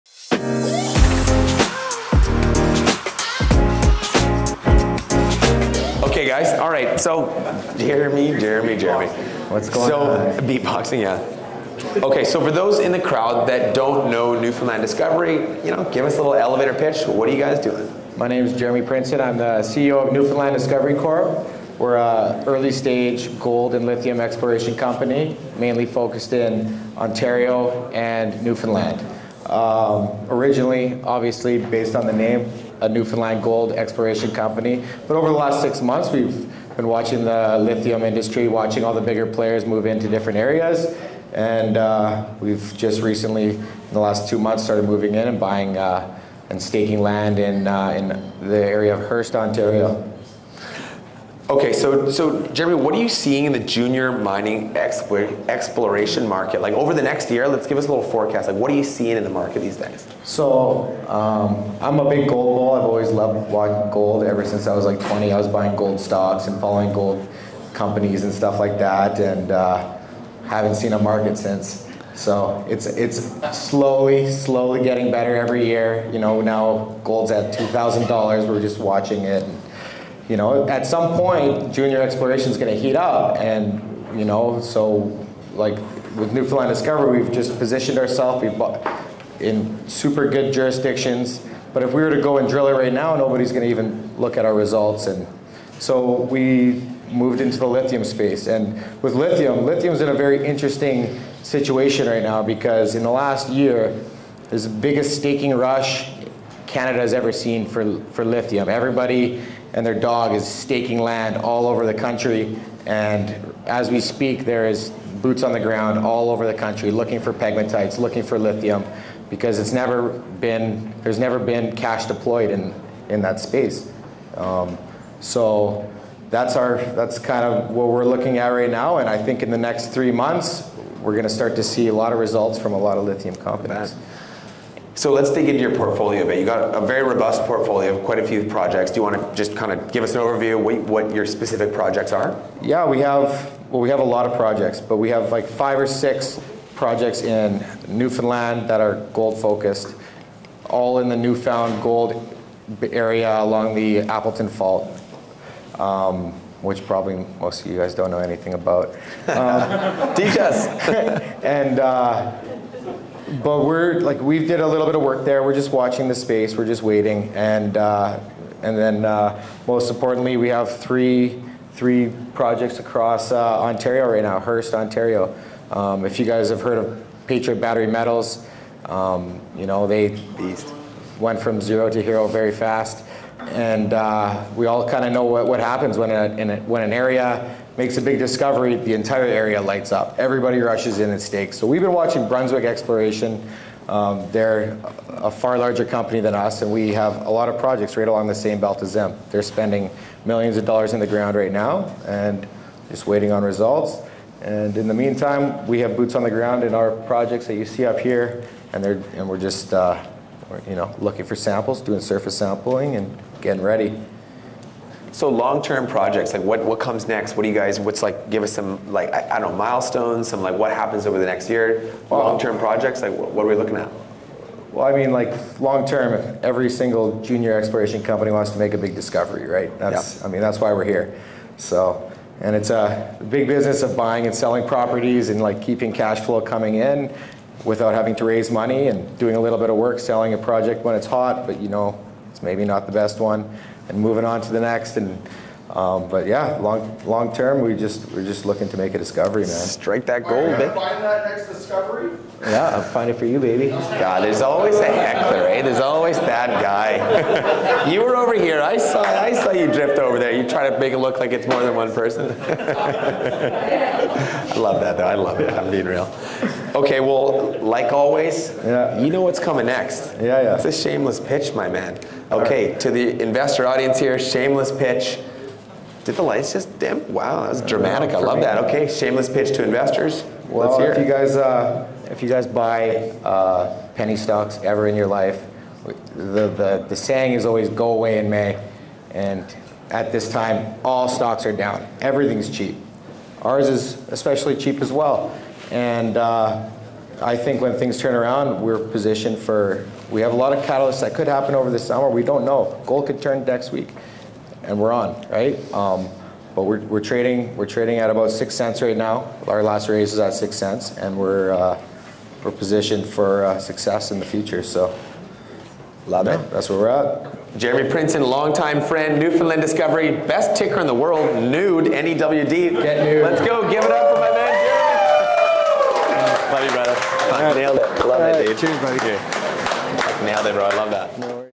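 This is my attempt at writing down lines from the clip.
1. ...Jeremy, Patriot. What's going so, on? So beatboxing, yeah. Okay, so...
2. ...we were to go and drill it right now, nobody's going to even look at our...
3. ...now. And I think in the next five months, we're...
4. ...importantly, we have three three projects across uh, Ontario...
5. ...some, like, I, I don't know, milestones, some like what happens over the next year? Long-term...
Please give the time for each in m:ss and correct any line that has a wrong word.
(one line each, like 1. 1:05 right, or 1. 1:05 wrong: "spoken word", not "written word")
1. 0:08 wrong: "Jeremy", not "Patriot"
2. 1:31 right
3. 2:08 wrong: "three", not "five"
4. 2:49 right
5. 3:38 right.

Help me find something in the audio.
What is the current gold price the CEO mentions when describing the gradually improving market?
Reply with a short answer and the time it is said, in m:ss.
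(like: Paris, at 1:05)
$2,000, at 1:17.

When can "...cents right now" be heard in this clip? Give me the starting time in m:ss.
5:08.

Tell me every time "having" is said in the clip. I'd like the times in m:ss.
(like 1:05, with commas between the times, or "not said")
3:57.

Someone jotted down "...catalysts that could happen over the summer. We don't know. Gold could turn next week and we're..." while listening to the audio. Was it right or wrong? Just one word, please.
right.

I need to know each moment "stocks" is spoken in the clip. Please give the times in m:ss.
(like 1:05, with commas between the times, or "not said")
1:05, 4:44, 4:51.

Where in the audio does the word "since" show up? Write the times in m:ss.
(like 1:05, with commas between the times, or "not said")
1:04, 1:11.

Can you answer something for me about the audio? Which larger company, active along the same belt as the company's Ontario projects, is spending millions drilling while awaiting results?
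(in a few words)
Brunswick Exploration.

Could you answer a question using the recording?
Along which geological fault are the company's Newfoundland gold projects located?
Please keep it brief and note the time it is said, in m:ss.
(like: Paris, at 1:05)
Appleton Fault, at 2:33.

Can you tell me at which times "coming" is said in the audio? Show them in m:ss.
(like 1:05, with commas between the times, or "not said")
3:56, 4:29.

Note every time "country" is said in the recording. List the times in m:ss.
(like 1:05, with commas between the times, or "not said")
1:51, 1:56.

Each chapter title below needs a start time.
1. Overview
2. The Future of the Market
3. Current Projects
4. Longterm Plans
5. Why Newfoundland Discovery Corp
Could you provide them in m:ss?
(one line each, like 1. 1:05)
1. 0:18
2. 1:00
3. 2:15
4. 3:35
5. 4:36.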